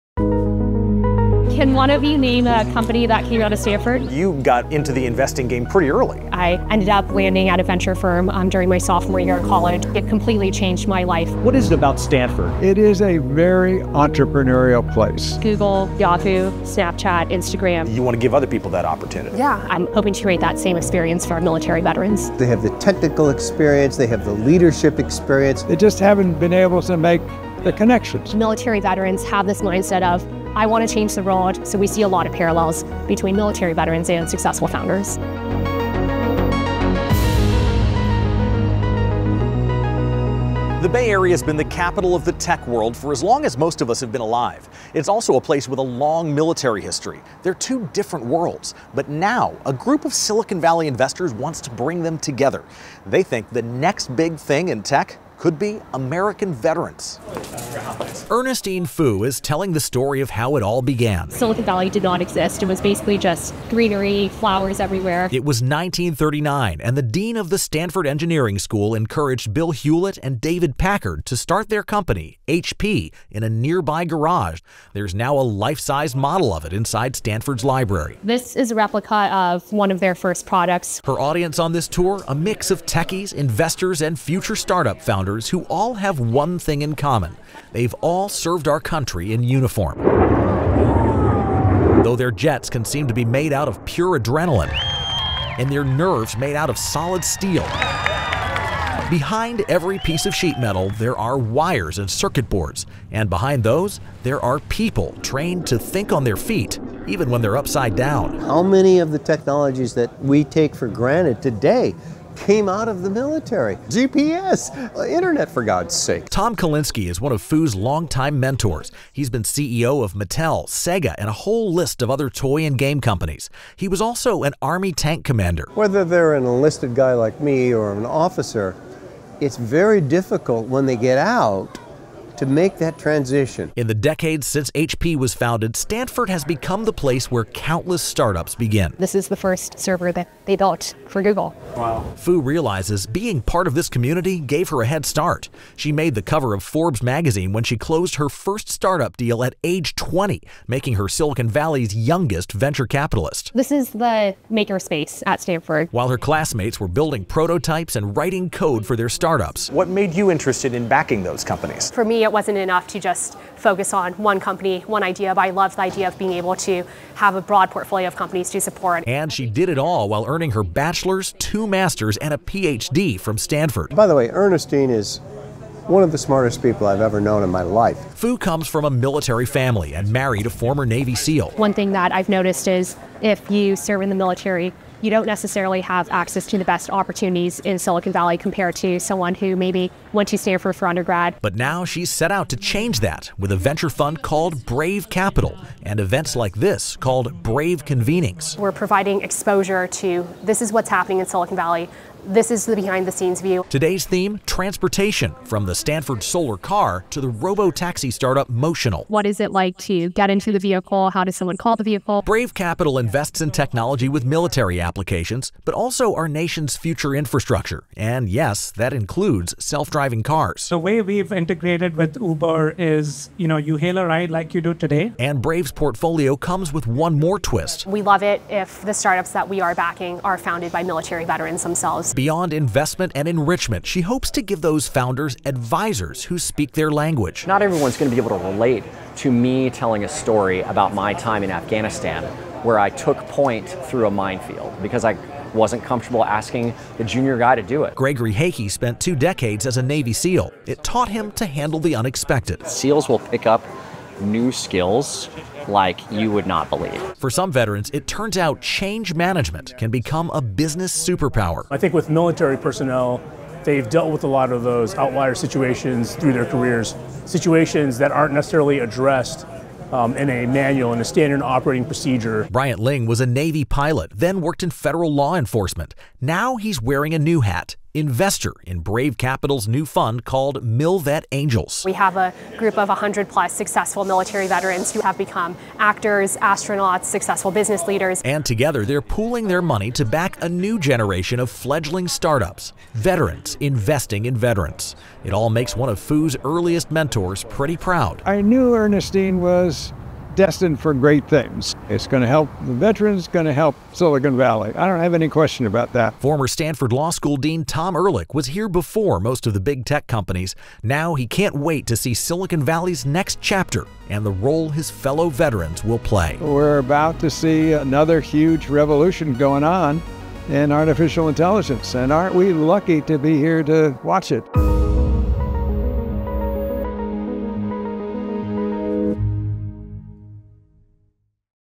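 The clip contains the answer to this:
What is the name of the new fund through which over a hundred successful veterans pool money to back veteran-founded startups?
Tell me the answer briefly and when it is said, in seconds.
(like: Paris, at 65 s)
MilVet Angels, at 280 s.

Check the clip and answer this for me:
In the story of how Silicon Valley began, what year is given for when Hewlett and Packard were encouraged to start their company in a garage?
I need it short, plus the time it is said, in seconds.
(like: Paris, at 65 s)
1939, at 65 s.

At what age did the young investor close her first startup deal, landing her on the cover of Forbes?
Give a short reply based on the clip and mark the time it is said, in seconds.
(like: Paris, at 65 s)
20, at 149 s.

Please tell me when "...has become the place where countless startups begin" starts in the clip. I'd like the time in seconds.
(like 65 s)
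136 s.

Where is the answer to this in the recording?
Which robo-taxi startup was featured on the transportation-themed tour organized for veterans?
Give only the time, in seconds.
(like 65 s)
208 s.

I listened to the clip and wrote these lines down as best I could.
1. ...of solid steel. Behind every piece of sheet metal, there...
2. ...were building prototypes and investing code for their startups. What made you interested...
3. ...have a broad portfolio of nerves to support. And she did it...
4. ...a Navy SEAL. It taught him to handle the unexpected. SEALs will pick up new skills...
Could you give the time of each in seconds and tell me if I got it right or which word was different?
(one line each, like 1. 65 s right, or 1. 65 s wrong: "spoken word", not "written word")
1. 96 s right
2. 156 s wrong: "writing", not "investing"
3. 167 s wrong: "companies", not "nerves"
4. 249 s right.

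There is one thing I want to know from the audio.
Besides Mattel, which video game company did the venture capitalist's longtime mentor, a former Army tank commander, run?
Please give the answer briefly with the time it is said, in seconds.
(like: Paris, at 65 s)
Sega, at 120 s.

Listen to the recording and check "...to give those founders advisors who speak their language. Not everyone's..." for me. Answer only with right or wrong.
right.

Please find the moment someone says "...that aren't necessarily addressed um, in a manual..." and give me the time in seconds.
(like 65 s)
267 s.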